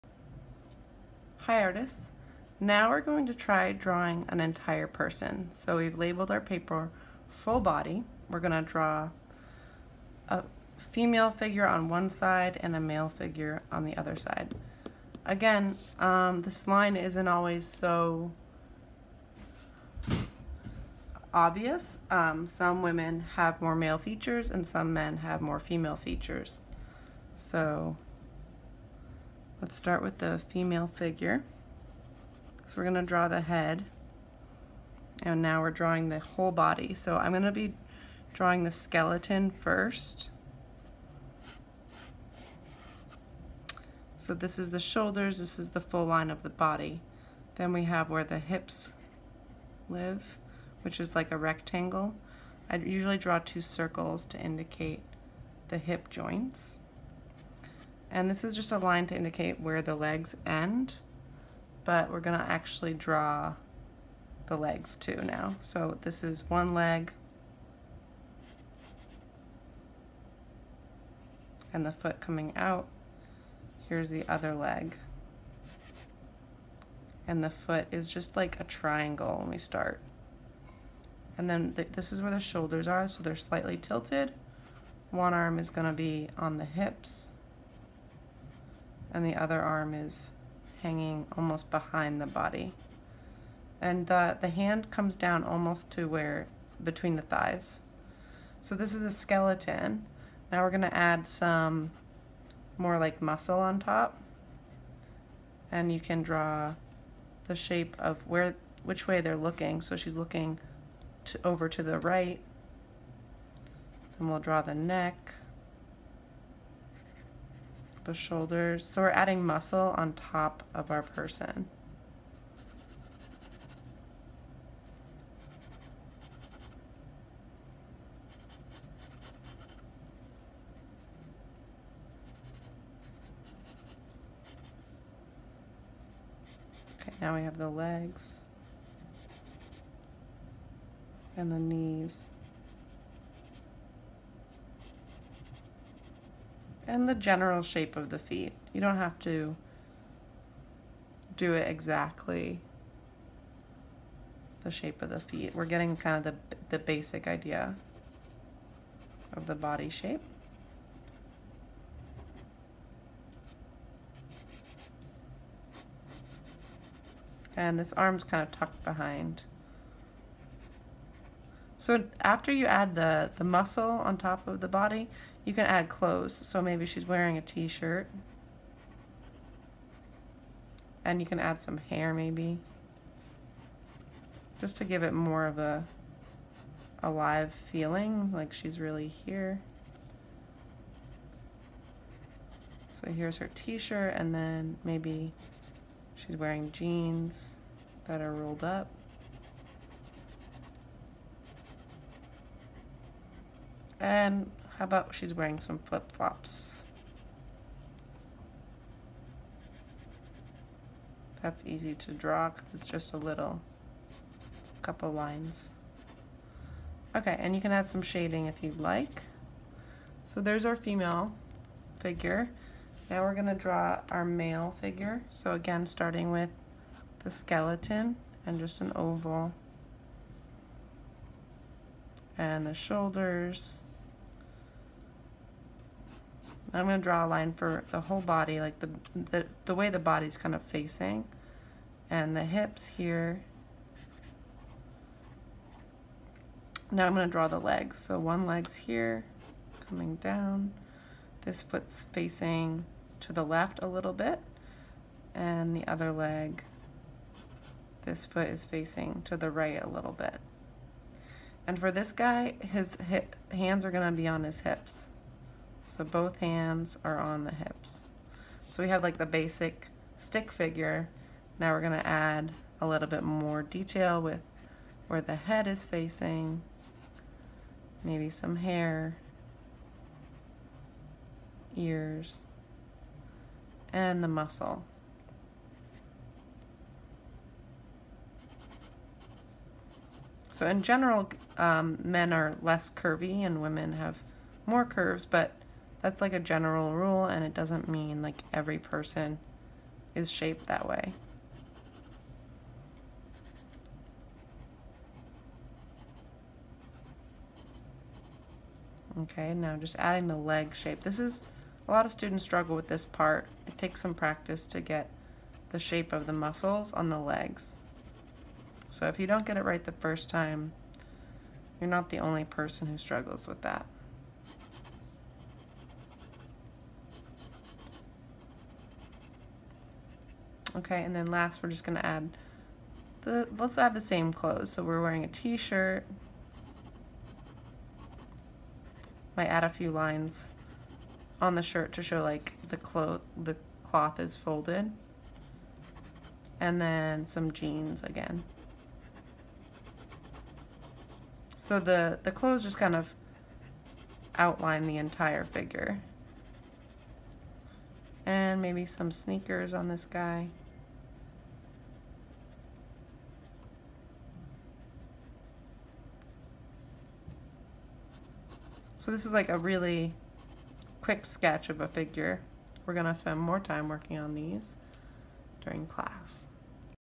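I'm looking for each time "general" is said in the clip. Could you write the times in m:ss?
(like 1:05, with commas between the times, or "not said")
2:27, 4:50, 4:56.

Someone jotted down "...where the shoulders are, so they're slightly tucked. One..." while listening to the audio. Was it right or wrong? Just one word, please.
wrong.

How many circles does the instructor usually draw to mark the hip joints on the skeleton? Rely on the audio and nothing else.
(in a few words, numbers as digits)
2.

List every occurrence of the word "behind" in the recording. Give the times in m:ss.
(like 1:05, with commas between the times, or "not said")
1:31, 2:48.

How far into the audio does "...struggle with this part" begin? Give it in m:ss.
5:12.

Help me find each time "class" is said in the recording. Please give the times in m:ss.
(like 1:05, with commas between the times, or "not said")
6:15.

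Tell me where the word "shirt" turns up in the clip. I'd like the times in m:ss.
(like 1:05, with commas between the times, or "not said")
2:57, 3:13, 5:35, 5:41.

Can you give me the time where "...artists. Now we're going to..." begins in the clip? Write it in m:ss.
0:01.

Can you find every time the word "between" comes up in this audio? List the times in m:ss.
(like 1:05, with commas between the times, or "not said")
1:36.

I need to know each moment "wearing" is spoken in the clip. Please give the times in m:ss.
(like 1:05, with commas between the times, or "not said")
2:57, 3:16, 3:25, 5:35.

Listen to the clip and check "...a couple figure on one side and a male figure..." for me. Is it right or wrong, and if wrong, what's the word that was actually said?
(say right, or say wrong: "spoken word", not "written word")
wrong: "female", not "couple".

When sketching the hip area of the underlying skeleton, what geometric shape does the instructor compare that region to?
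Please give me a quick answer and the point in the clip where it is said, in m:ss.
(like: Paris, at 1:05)
rectangle, at 0:51.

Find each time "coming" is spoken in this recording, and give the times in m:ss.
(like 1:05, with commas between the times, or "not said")
1:12, 4:09.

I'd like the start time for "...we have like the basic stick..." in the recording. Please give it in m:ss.
4:28.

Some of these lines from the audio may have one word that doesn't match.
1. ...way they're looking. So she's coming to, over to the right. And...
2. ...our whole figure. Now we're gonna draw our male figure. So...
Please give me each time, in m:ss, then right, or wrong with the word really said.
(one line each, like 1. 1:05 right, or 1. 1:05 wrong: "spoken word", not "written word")
1. 1:49 wrong: "looking", not "coming"
2. 3:40 wrong: "female", not "whole".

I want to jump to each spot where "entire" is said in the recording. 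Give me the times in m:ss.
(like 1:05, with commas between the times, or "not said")
0:04, 5:54.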